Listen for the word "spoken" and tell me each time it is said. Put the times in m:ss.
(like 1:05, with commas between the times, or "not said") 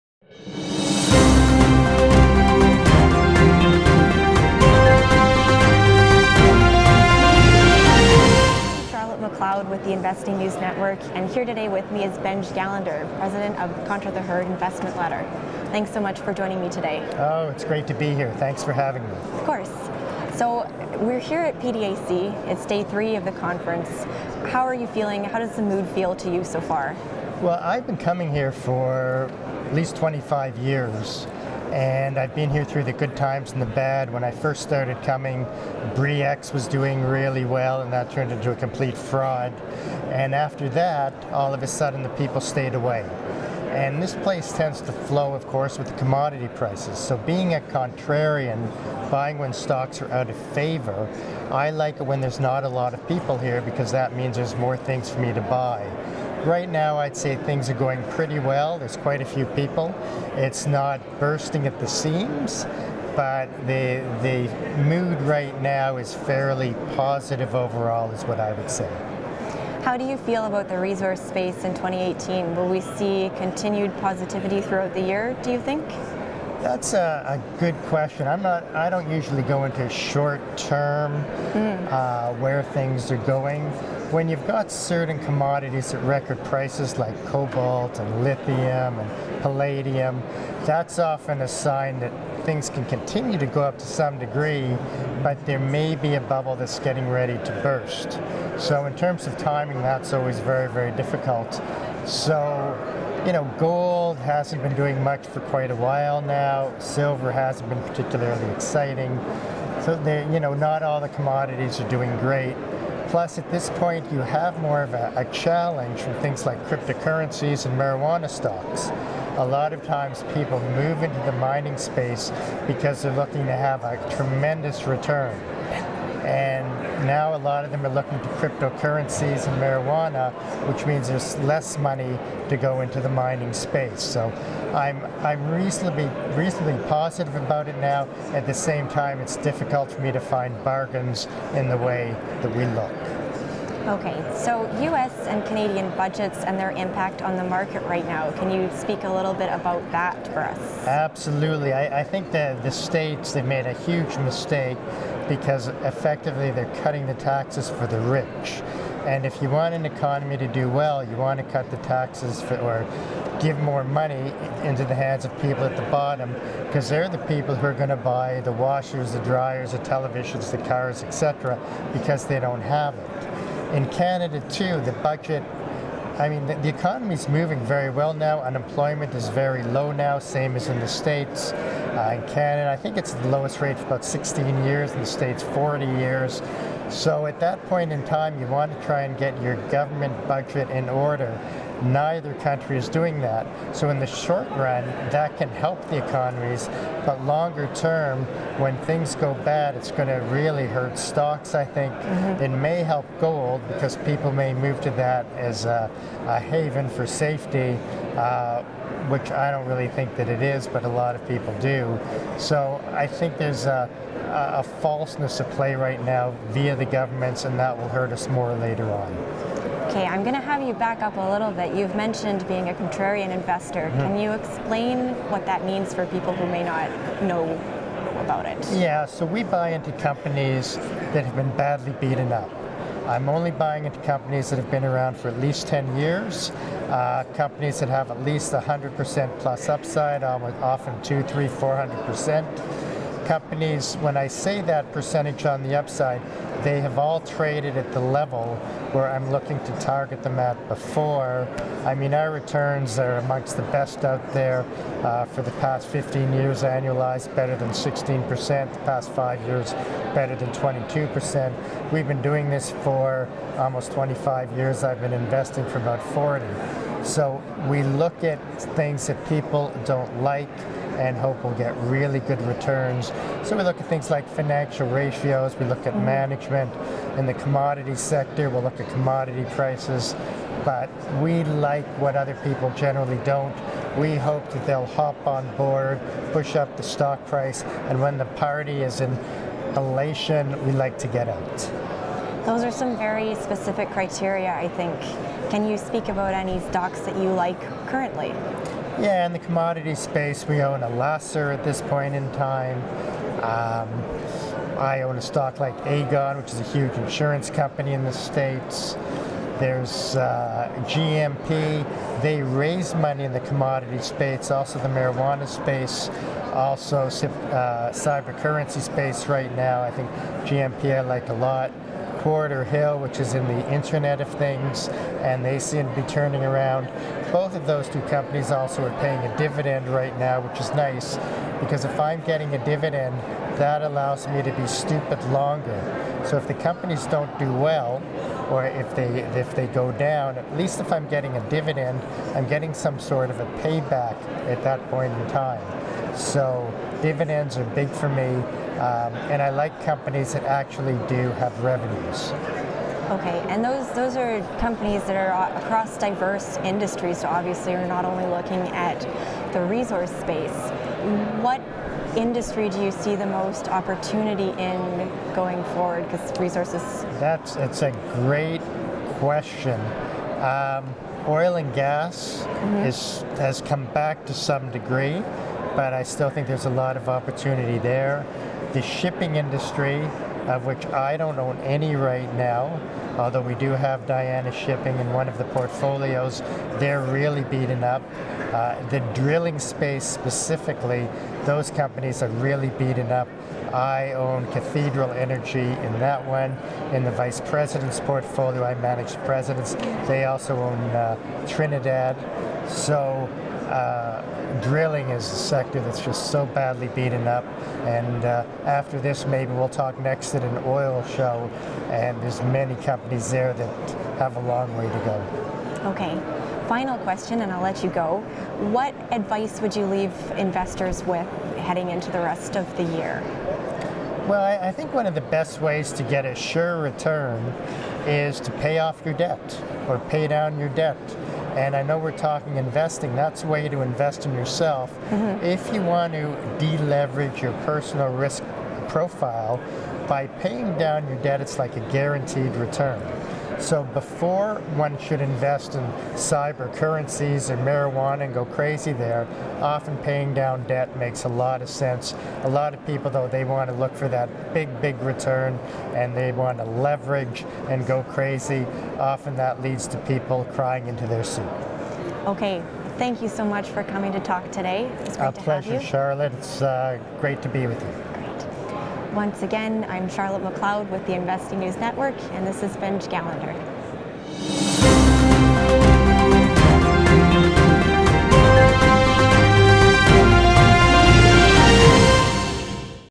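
not said.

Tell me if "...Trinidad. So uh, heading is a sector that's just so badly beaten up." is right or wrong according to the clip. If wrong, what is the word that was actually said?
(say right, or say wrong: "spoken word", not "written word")
wrong: "drilling", not "heading".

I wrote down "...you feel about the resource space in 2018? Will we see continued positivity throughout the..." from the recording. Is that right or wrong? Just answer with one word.
right.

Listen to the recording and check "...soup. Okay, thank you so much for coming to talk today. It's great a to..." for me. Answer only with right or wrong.
right.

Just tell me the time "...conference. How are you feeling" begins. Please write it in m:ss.
0:23.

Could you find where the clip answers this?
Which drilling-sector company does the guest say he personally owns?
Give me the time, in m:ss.
6:34.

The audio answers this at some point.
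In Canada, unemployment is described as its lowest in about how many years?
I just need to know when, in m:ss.
3:04.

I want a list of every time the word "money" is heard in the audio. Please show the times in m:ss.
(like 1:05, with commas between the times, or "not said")
2:11, 2:43, 5:12.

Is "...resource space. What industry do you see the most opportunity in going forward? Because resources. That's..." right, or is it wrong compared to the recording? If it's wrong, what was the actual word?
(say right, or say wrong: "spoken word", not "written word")
right.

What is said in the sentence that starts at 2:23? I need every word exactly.
Okay, so US and Canadian budgets and their impact on the market right now.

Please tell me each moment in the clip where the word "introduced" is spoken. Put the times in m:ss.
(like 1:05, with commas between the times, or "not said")
not said.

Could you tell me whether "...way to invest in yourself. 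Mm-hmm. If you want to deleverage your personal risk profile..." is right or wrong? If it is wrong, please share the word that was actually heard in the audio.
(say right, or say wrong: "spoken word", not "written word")
right.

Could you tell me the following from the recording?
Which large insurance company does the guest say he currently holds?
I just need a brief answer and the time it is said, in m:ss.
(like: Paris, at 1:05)
Aegon, at 5:05.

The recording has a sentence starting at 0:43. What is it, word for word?
And this place tends to flow, of course, with the commodity prices.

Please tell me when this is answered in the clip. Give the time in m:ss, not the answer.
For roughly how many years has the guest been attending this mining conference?
0:29.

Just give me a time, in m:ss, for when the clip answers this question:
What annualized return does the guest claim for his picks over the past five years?
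4:20.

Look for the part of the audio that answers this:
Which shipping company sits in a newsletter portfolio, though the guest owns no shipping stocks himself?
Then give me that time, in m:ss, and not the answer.
6:24.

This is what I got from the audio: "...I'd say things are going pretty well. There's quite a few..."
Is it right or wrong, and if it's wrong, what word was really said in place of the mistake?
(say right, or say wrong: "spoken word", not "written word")
right.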